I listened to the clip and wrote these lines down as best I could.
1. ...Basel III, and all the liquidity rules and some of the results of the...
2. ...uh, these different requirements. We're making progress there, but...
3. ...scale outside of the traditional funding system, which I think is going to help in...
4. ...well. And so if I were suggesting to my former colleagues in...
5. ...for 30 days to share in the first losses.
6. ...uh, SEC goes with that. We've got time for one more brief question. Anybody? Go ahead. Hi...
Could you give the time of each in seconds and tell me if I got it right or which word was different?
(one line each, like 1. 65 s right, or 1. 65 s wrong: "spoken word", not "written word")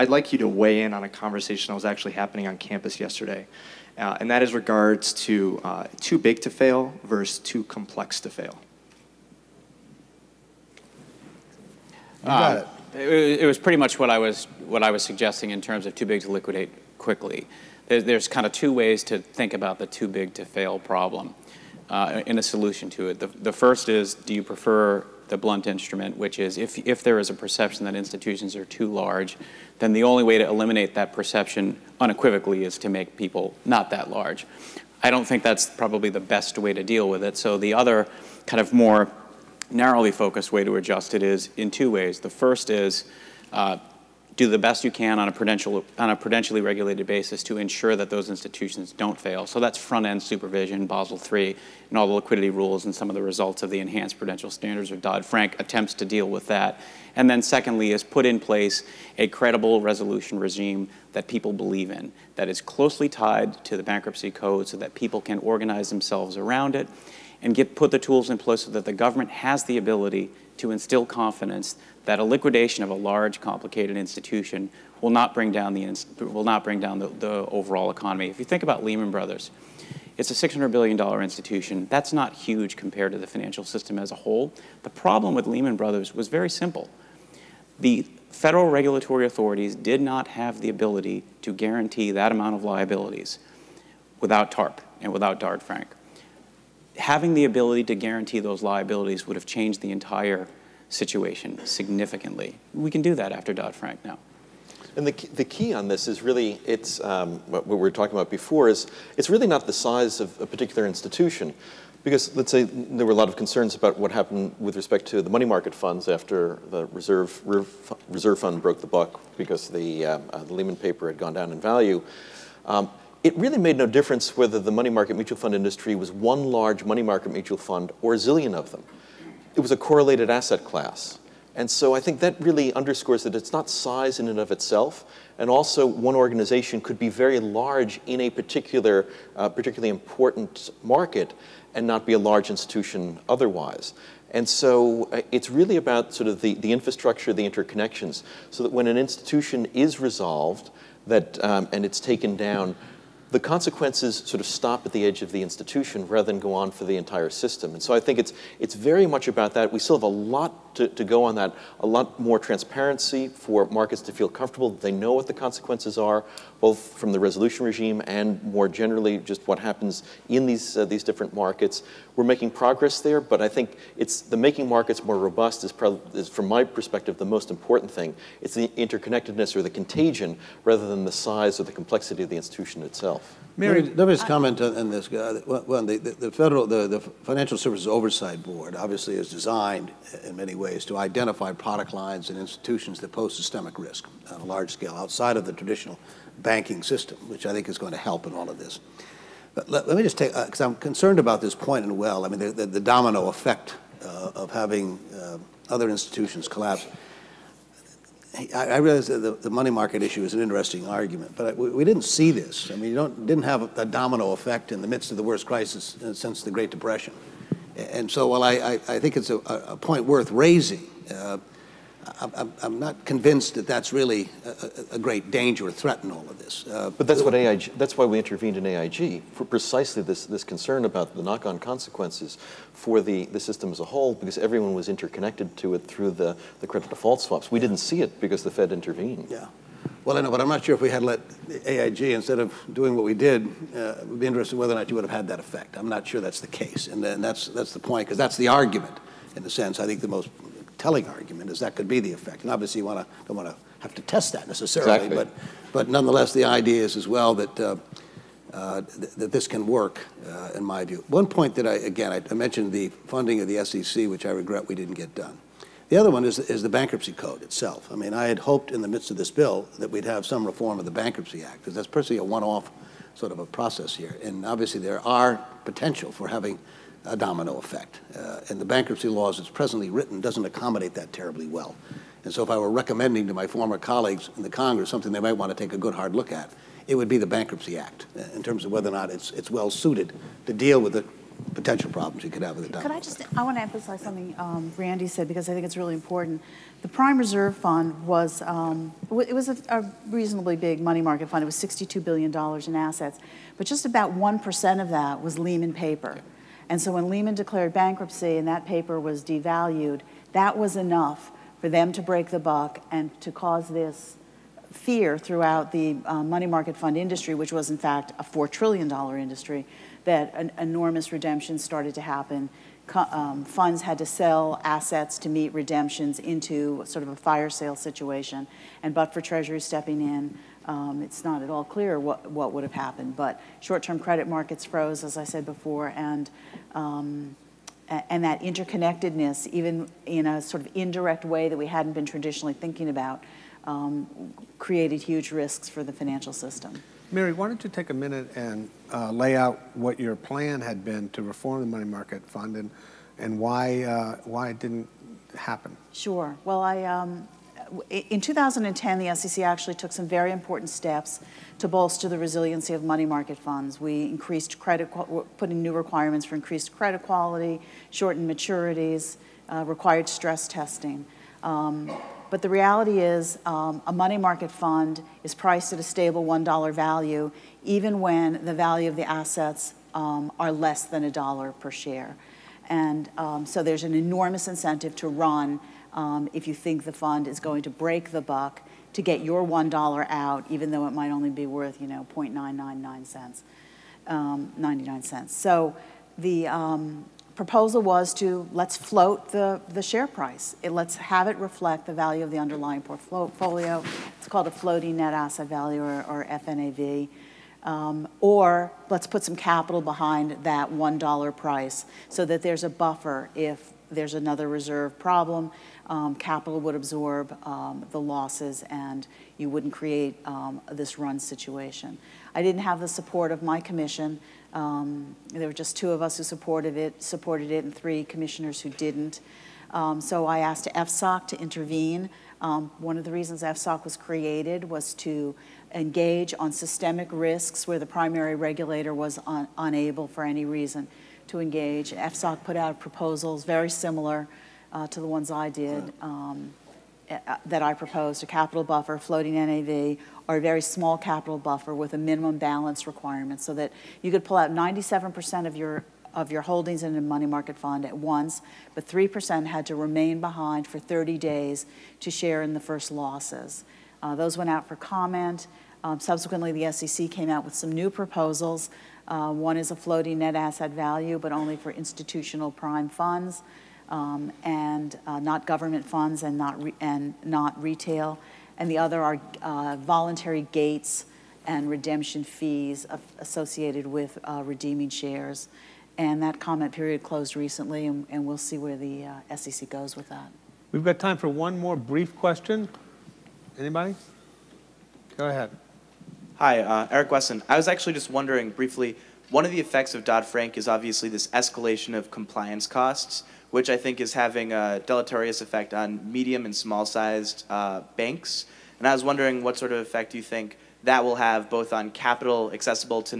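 1. 50 s right
2. 170 s wrong: "markets", not "requirements"
3. 194 s wrong: "banking", not "funding"
4. 281 s wrong: "recommending", not "suggesting"
5. 460 s right
6. 489 s right.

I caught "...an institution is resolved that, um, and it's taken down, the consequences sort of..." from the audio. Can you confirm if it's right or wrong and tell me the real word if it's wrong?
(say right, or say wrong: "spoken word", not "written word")
right.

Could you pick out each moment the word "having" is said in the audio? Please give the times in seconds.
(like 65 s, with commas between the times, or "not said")
96 s, 204 s, 276 s, 504 s.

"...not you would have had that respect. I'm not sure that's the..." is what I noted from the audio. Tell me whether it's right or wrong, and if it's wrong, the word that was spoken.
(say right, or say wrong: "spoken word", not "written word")
wrong: "effect", not "respect".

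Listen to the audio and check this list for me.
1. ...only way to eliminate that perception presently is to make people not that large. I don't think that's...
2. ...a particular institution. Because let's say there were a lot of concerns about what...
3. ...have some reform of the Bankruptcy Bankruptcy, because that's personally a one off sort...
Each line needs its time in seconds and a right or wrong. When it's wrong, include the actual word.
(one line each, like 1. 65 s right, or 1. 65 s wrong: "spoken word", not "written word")
1. 30 s wrong: "unequivocally", not "presently"
2. 110 s right
3. 270 s wrong: "Act", not "Bankruptcy".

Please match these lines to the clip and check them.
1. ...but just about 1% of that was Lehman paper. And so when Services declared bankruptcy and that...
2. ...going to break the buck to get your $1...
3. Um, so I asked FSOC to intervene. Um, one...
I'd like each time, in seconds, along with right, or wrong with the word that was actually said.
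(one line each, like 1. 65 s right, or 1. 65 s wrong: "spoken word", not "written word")
1. 303 s wrong: "Lehman", not "Services"
2. 387 s right
3. 429 s right.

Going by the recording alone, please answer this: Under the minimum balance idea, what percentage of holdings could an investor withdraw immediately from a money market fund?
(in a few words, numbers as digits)
97%.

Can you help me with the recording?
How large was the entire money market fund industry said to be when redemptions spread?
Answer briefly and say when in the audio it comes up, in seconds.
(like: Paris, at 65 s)
$4 trillion, at 318 s.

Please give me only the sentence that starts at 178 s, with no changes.
It's the interconnectedness or the contagion rather than the size or the complexity of the institution itself.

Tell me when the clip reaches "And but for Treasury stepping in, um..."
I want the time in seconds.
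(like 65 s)
328 s.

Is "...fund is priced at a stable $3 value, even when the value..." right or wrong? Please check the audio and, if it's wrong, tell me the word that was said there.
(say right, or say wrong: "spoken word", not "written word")
wrong: "1", not "3".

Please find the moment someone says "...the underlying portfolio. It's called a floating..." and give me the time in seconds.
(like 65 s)
402 s.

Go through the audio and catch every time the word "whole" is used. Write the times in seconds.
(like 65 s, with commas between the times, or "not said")
84 s, 233 s.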